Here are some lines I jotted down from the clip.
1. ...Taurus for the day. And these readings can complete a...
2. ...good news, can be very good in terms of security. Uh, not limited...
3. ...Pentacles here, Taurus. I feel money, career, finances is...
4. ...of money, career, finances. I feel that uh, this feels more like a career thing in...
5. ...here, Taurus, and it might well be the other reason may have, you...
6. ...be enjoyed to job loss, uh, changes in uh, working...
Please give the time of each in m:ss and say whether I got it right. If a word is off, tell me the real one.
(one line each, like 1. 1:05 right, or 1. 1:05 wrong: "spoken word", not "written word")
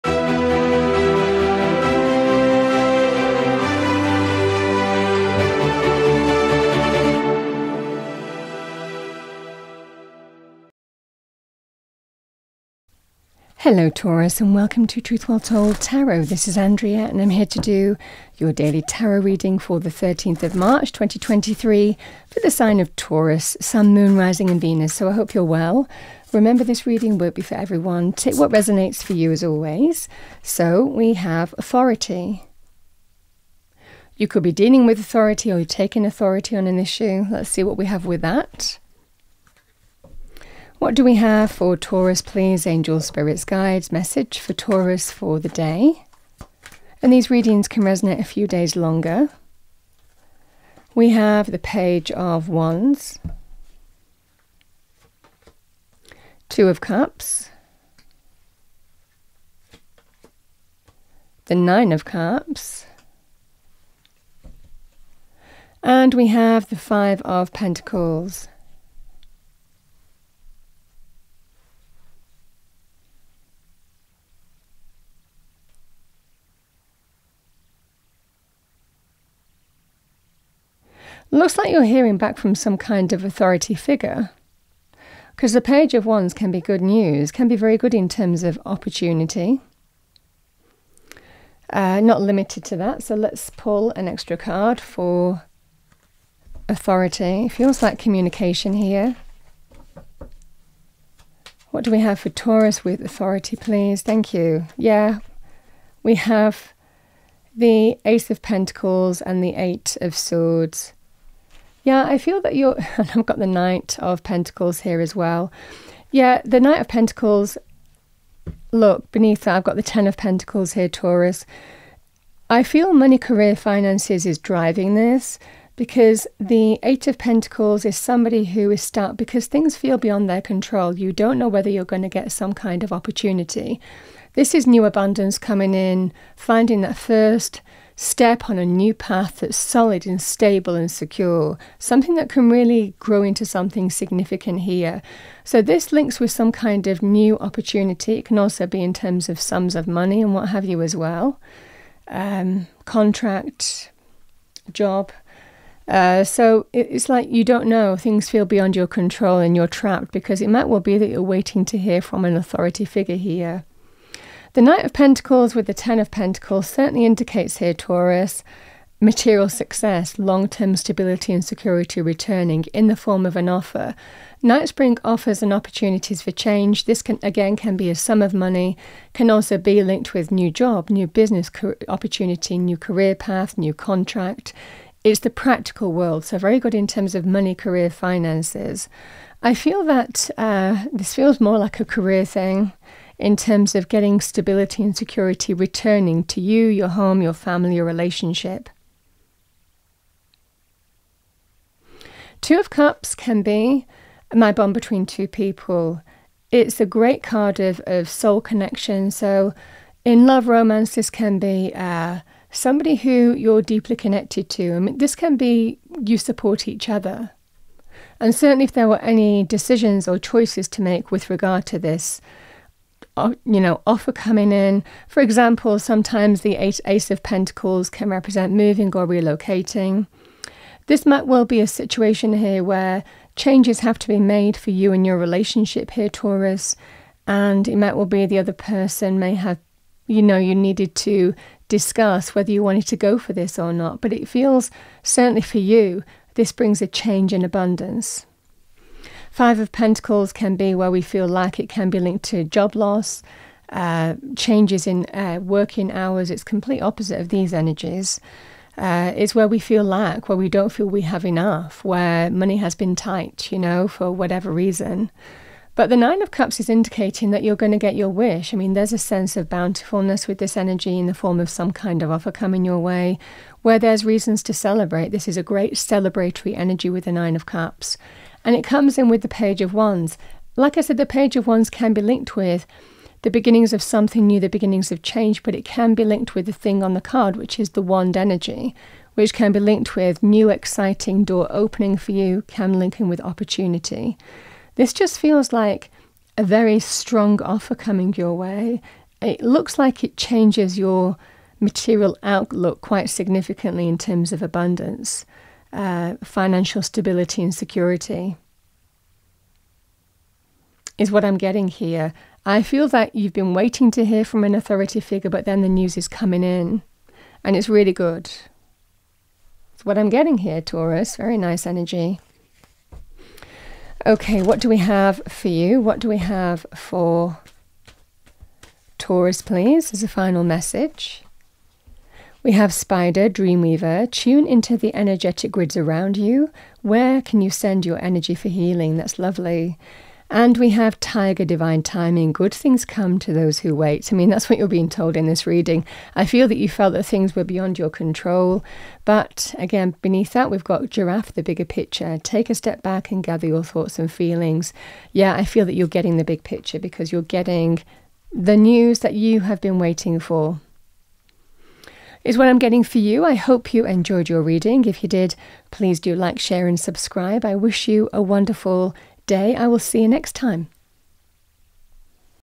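1. 0:44 wrong: "resonate", not "complete"
2. 1:26 wrong: "opportunity", not "security"
3. 2:00 right
4. 3:07 right
5. 3:55 wrong: "person", not "reason"
6. 4:11 wrong: "linked", not "enjoyed".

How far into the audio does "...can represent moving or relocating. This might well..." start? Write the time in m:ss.
3:47.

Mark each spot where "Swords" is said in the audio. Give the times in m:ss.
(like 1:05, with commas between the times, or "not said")
1:50.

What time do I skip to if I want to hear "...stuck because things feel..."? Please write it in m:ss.
2:08.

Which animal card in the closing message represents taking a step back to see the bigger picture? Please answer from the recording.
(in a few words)
Giraffe.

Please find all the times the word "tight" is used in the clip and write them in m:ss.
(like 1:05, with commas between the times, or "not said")
4:22.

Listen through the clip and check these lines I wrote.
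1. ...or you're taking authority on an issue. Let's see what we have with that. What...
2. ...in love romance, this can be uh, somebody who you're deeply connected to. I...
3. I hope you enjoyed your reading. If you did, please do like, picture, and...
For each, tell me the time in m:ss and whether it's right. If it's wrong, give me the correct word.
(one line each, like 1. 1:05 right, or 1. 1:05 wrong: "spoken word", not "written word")
1. 0:35 right
2. 3:30 right
3. 6:03 wrong: "share", not "picture".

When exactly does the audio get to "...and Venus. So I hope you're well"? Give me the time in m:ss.
0:24.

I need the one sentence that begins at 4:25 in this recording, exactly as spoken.
But the Nine of Cups is indicating that you're going to get your wish.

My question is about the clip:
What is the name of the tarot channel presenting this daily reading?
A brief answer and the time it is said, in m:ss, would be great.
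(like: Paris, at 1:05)
Truth Well Told Tarot, at 0:14.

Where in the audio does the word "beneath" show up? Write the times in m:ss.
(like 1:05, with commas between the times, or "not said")
1:59, 5:50.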